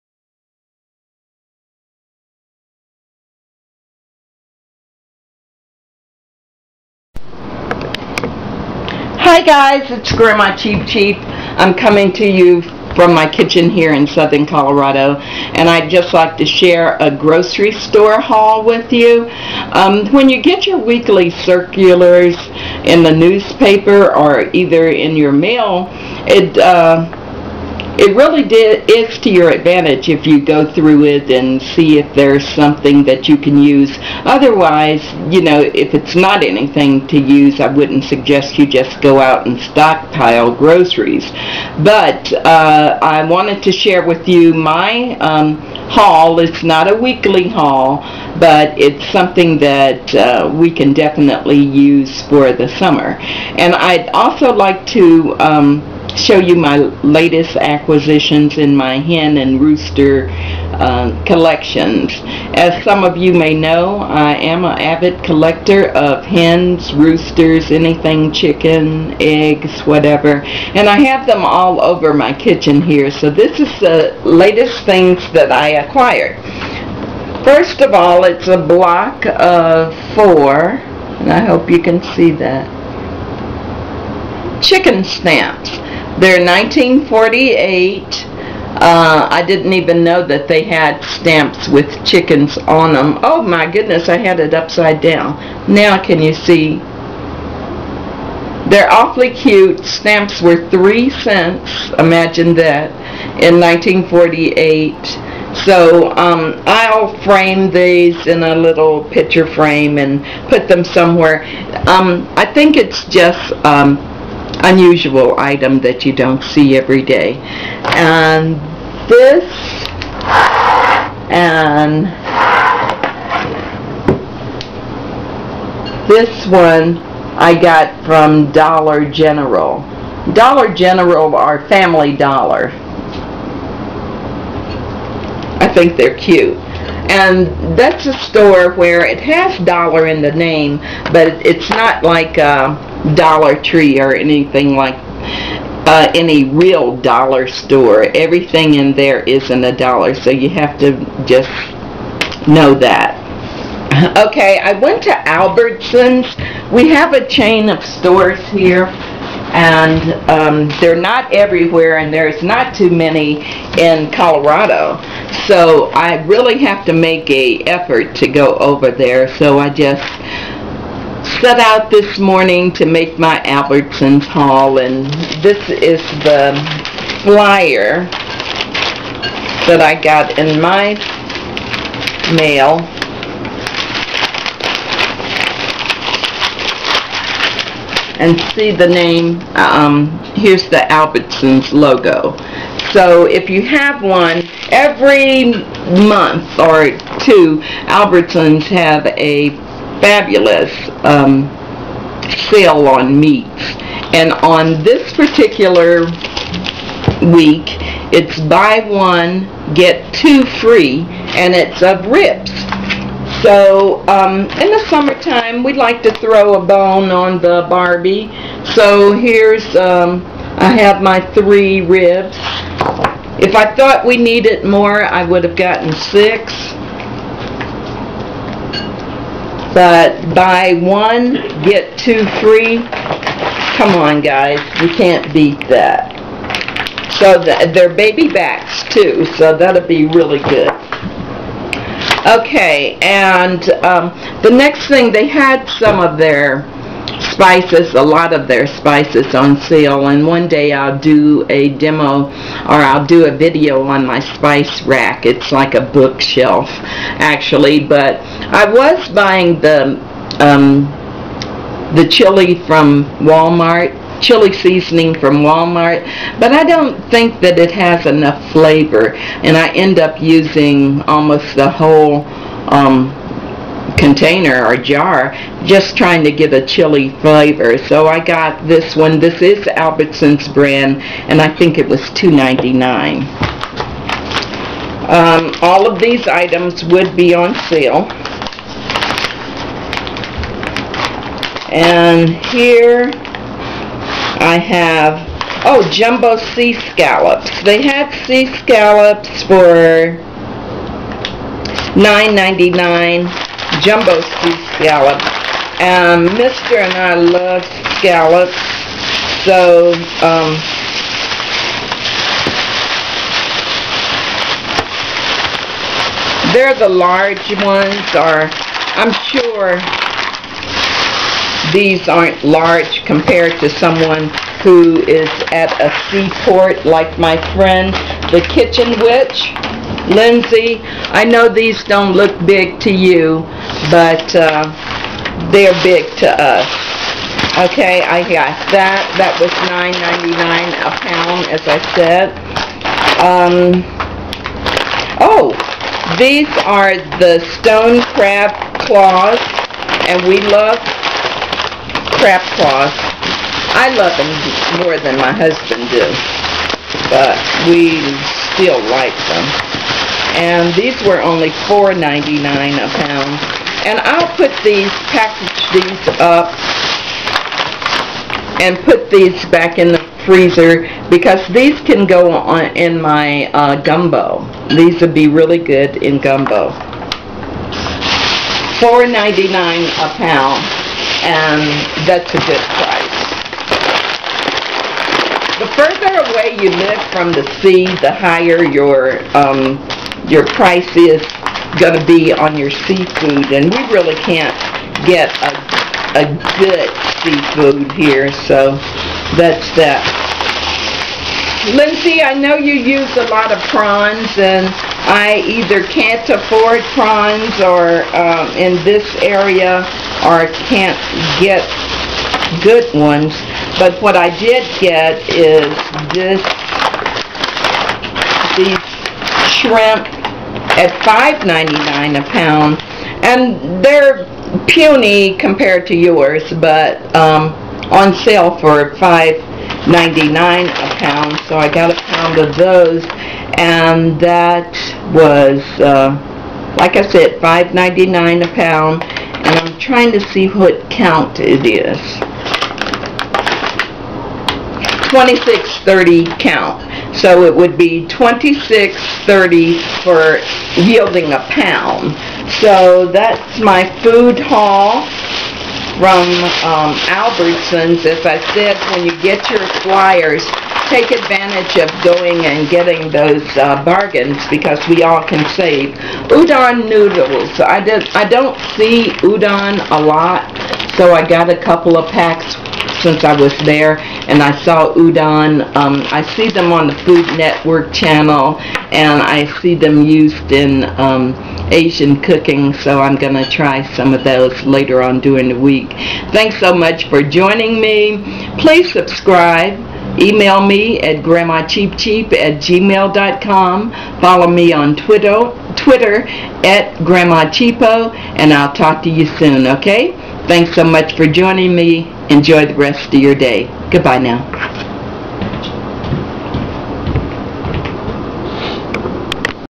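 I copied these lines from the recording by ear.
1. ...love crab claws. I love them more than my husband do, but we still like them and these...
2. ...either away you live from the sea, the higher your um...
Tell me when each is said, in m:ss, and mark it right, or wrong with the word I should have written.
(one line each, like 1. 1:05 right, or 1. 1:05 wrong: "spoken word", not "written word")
1. 5:50 right
2. 6:25 wrong: "further", not "either".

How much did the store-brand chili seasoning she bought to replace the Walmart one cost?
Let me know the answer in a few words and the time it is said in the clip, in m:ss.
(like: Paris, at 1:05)
$2.99, at 4:42.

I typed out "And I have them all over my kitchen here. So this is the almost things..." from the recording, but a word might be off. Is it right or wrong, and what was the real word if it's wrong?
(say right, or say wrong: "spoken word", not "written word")
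wrong: "latest", not "almost".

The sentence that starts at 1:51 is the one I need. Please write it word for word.
Um, I think it's just um, unusual item that you don't see every day.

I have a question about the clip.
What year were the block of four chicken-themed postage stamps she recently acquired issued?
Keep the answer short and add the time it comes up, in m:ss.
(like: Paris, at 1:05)
1948, at 1:26.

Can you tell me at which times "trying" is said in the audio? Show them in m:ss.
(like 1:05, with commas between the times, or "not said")
4:35, 7:19.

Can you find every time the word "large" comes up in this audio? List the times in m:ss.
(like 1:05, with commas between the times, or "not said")
5:16, 5:22.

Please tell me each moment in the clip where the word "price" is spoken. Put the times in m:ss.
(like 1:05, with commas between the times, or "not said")
6:22, 6:30.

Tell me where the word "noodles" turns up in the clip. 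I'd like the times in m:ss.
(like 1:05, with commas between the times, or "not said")
7:46.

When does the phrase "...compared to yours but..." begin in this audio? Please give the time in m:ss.
7:05.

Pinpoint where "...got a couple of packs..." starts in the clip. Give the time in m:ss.
7:51.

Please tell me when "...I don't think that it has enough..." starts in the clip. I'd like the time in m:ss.
4:26.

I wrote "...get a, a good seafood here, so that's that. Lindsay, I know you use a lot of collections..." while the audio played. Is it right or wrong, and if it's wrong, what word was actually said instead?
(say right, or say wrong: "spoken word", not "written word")
wrong: "prawns", not "collections".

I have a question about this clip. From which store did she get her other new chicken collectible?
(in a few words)
Dollar General.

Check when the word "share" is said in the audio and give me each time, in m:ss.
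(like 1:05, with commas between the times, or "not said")
0:16, 0:43.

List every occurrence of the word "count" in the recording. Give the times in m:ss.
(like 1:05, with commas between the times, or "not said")
7:20, 7:26.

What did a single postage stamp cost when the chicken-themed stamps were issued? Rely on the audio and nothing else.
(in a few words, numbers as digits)
3 cents.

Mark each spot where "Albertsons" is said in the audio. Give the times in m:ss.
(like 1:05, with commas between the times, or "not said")
2:35, 2:53, 3:10, 3:17, 4:39, 7:37.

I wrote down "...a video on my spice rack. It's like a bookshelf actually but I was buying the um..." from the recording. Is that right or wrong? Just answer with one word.
right.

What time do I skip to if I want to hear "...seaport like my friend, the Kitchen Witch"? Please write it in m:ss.
5:26.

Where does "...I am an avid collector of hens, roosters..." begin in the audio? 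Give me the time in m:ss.
1:03.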